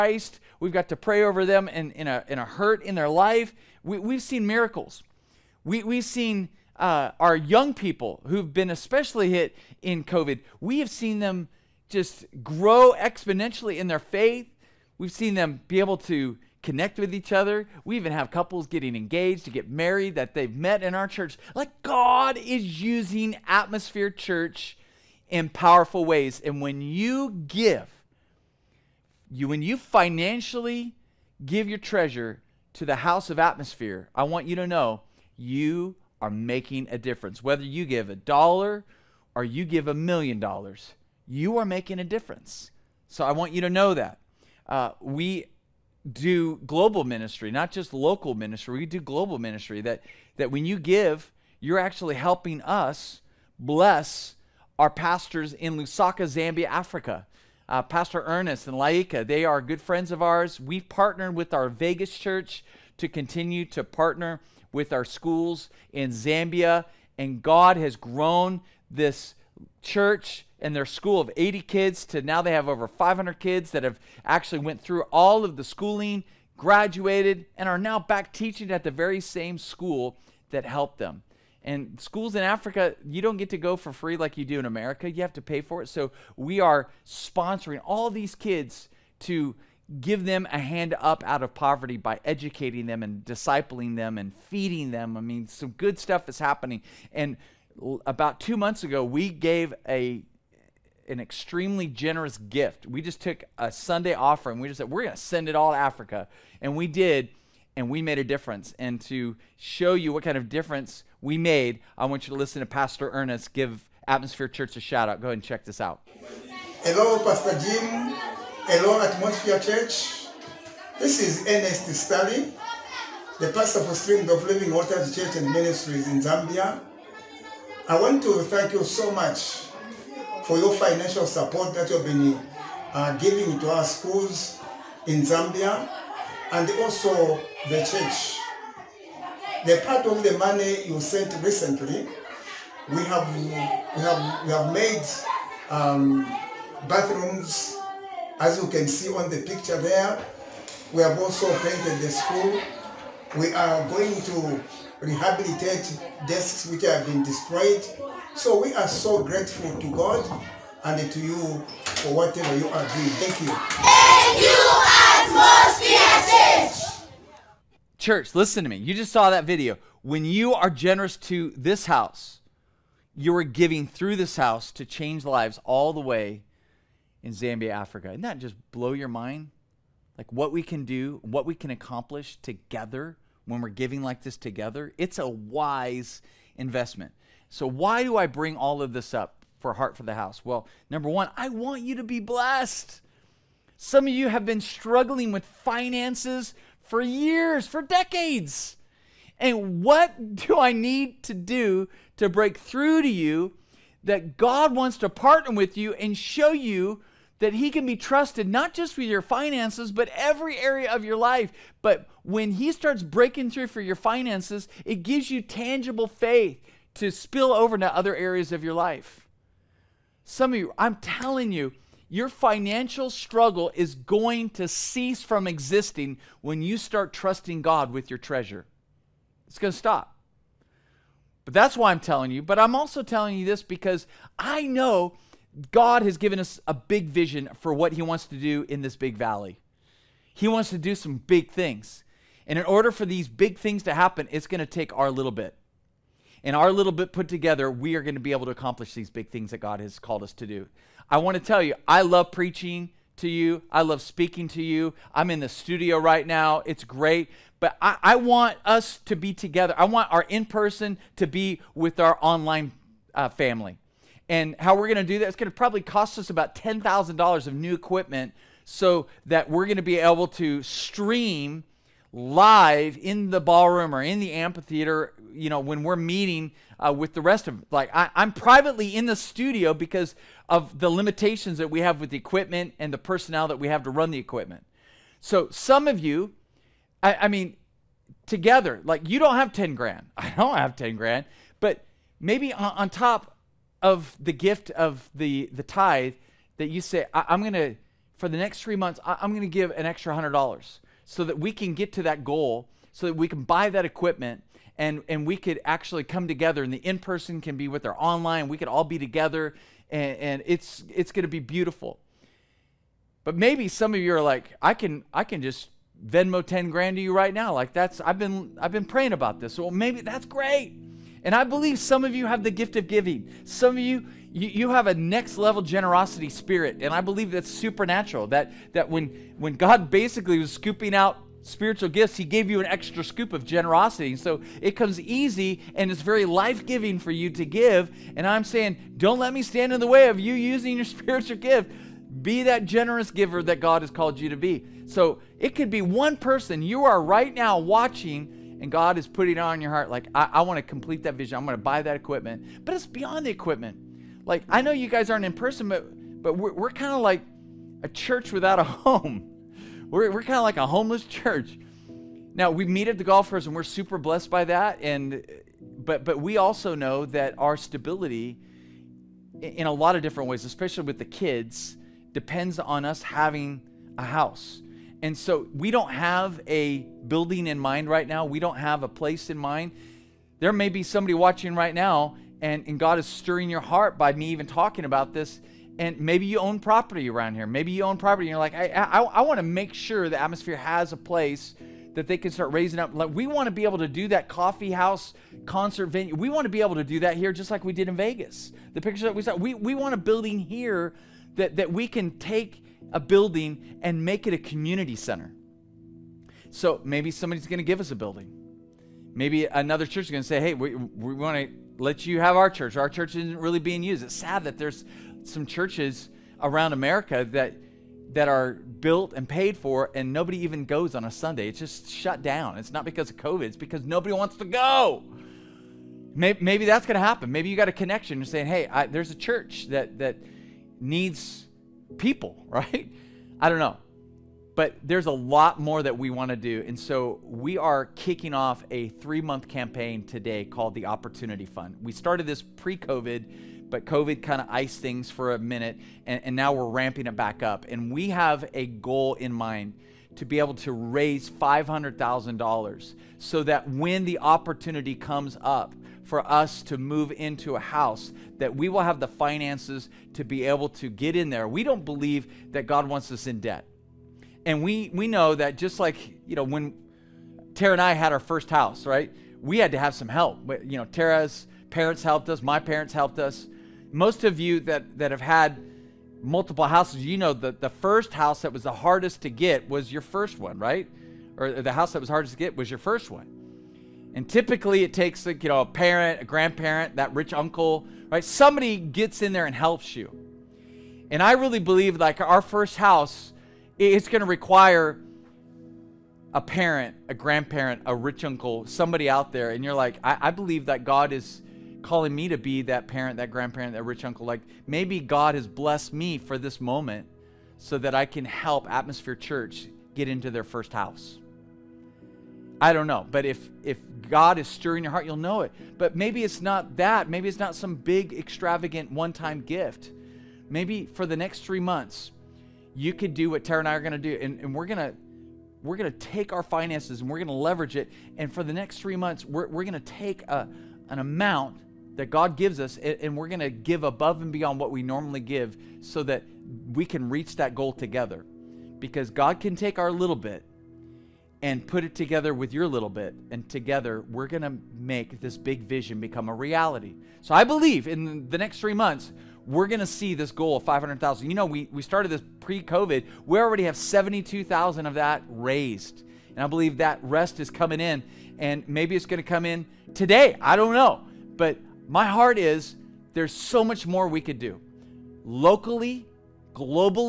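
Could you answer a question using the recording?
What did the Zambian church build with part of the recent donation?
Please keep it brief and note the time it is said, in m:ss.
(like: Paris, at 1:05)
bathrooms, at 2:26.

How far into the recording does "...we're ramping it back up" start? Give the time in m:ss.
7:26.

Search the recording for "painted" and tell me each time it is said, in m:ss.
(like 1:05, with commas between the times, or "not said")
2:31.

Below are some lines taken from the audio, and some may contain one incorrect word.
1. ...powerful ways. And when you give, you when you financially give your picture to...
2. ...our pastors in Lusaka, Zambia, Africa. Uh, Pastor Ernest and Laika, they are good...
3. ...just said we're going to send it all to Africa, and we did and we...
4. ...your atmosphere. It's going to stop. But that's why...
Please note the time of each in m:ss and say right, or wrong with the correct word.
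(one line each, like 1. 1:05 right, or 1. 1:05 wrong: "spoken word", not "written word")
1. 0:25 wrong: "treasure", not "picture"
2. 0:54 right
3. 1:44 right
4. 3:48 wrong: "treasure", not "atmosphere".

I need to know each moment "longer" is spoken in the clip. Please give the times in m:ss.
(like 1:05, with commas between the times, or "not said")
not said.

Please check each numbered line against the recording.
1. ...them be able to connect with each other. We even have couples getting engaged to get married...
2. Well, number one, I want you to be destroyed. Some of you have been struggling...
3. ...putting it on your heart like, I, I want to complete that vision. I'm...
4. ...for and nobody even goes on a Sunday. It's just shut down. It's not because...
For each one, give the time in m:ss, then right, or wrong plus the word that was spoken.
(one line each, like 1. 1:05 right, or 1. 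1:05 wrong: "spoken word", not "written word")
1. 0:15 right
2. 3:10 wrong: "blessed", not "destroyed"
3. 5:49 right
4. 6:59 right.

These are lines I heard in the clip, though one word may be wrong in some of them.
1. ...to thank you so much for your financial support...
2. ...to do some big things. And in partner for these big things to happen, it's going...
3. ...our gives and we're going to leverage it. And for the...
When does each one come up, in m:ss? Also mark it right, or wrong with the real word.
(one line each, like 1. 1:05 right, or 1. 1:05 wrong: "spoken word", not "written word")
1. 2:08 right
2. 4:00 wrong: "order", not "partner"
3. 8:46 wrong: "finances", not "gives".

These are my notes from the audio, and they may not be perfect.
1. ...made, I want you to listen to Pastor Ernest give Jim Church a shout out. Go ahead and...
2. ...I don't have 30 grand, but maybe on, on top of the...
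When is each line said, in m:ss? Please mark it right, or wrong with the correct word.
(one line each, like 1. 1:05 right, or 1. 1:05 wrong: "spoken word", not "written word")
1. 1:51 wrong: "Atmosphere", not "Jim"
2. 4:50 wrong: "10", not "30".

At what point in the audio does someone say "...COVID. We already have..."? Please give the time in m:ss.
9:12.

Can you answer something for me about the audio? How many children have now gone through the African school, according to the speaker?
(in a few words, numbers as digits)
over 500.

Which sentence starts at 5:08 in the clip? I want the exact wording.
We could all be together and, and it's, it's going to be beautiful.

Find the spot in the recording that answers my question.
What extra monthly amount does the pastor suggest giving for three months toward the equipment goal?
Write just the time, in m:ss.
5:00.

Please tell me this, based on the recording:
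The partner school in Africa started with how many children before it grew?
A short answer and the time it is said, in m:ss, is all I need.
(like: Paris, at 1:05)
80, at 1:11.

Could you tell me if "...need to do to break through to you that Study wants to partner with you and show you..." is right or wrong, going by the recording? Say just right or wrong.
wrong.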